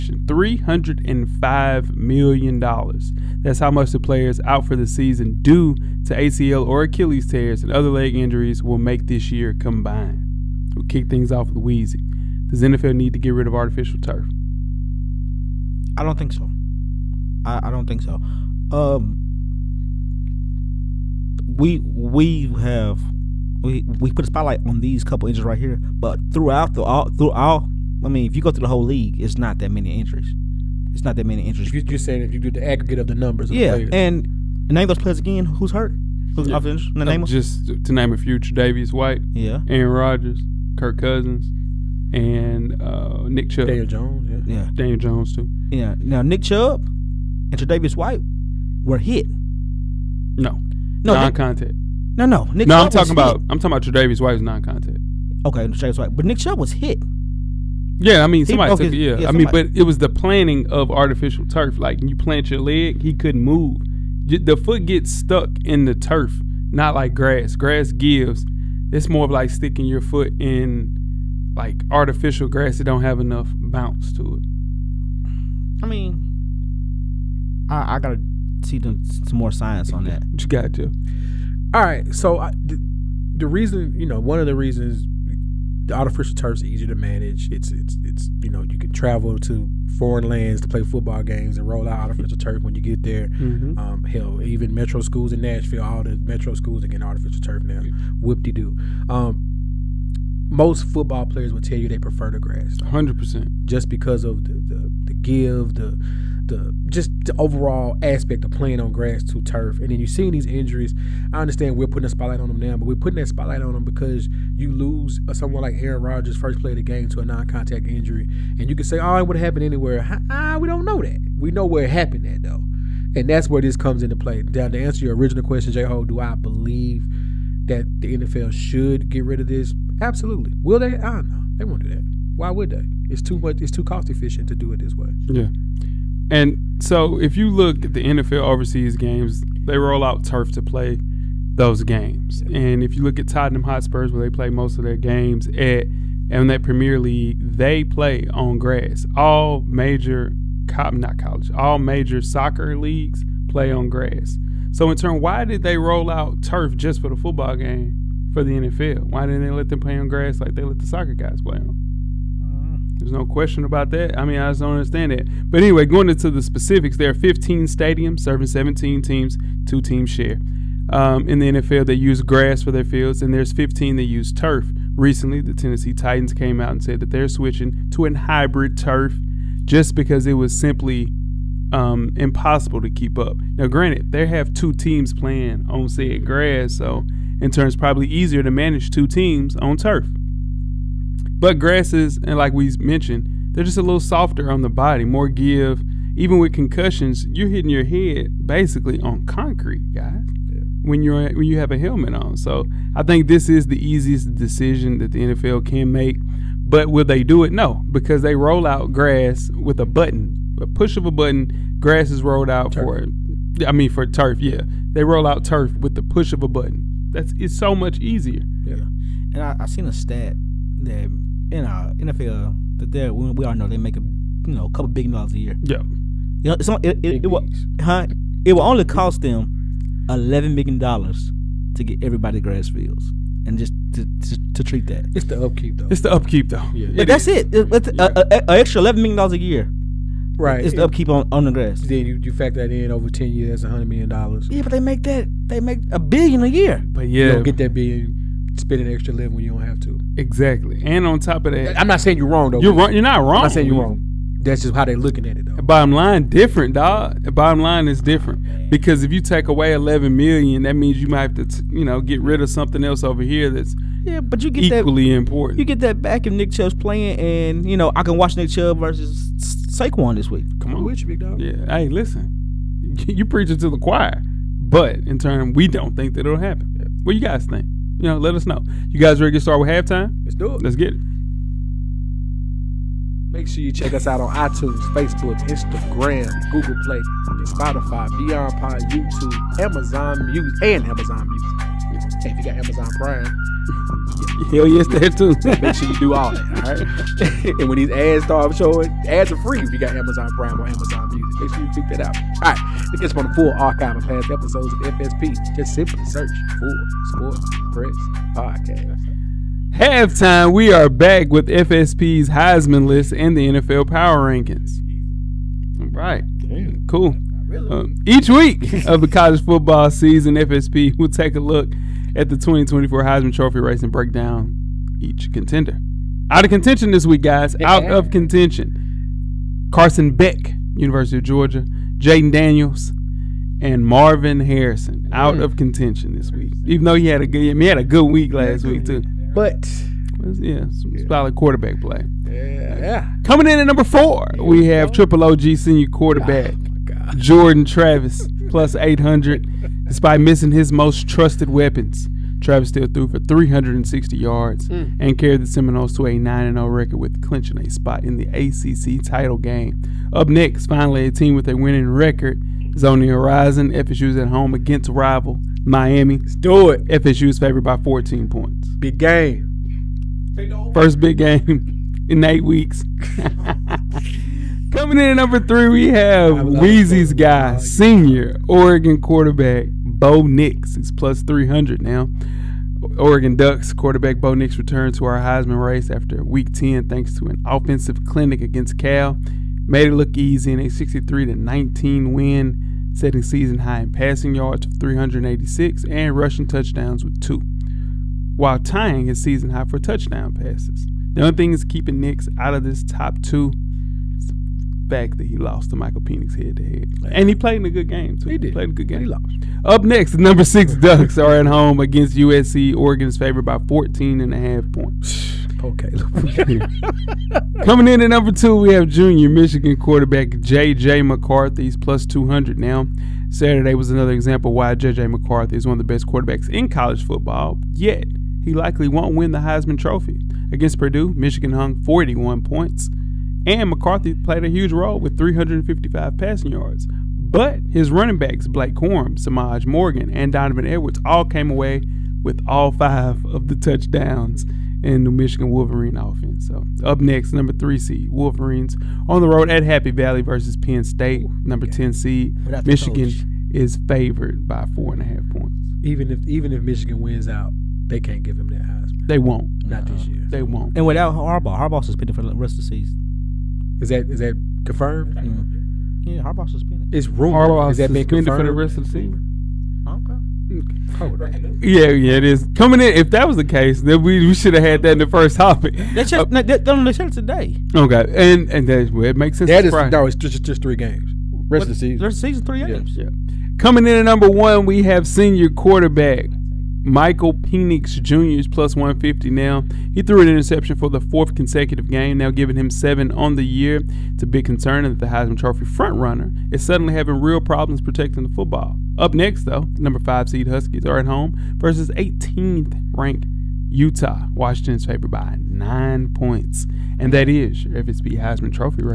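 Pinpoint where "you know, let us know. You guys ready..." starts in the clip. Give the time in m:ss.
4:37.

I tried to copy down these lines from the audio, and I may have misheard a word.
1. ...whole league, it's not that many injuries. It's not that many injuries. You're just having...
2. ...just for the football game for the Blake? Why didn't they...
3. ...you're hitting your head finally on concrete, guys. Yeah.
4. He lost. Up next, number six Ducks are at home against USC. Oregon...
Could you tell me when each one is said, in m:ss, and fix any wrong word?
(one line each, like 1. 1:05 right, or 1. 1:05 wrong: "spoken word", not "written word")
1. 0:28 wrong: "saying", not "having"
2. 2:36 wrong: "NFL", not "Blake"
3. 3:17 wrong: "basically", not "finally"
4. 6:48 right.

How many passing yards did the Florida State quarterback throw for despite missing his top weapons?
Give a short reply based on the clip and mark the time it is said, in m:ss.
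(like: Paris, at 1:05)
360, at 5:53.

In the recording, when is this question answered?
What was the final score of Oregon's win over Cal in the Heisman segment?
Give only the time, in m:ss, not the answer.
6:30.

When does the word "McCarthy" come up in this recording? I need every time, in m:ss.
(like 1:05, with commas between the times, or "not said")
7:00, 7:05, 7:13.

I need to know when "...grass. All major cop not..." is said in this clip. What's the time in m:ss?
2:28.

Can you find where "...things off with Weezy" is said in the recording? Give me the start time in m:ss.
0:11.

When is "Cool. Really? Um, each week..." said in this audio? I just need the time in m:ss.
5:16.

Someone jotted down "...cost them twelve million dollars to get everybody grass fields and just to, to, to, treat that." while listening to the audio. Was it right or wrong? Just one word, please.
wrong.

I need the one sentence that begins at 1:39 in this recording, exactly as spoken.
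Um, most football players will tell you they prefer the grass.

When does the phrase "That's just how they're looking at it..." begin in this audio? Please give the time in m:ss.
4:14.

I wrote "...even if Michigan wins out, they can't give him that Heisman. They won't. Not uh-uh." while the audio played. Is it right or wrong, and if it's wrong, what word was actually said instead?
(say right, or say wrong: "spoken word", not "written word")
right.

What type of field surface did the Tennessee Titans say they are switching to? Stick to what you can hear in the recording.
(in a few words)
hybrid turf.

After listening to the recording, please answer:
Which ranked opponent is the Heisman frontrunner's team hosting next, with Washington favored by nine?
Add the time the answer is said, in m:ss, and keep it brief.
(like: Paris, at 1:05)
Utah, at 8:23.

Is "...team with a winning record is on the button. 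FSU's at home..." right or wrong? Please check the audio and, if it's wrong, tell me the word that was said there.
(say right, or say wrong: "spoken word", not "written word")
wrong: "horizon", not "button".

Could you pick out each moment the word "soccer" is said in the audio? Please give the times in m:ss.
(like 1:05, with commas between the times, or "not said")
2:32, 2:40.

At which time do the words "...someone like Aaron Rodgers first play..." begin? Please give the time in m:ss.
1:55.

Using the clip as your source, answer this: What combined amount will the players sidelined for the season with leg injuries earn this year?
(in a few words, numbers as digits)
$305 million.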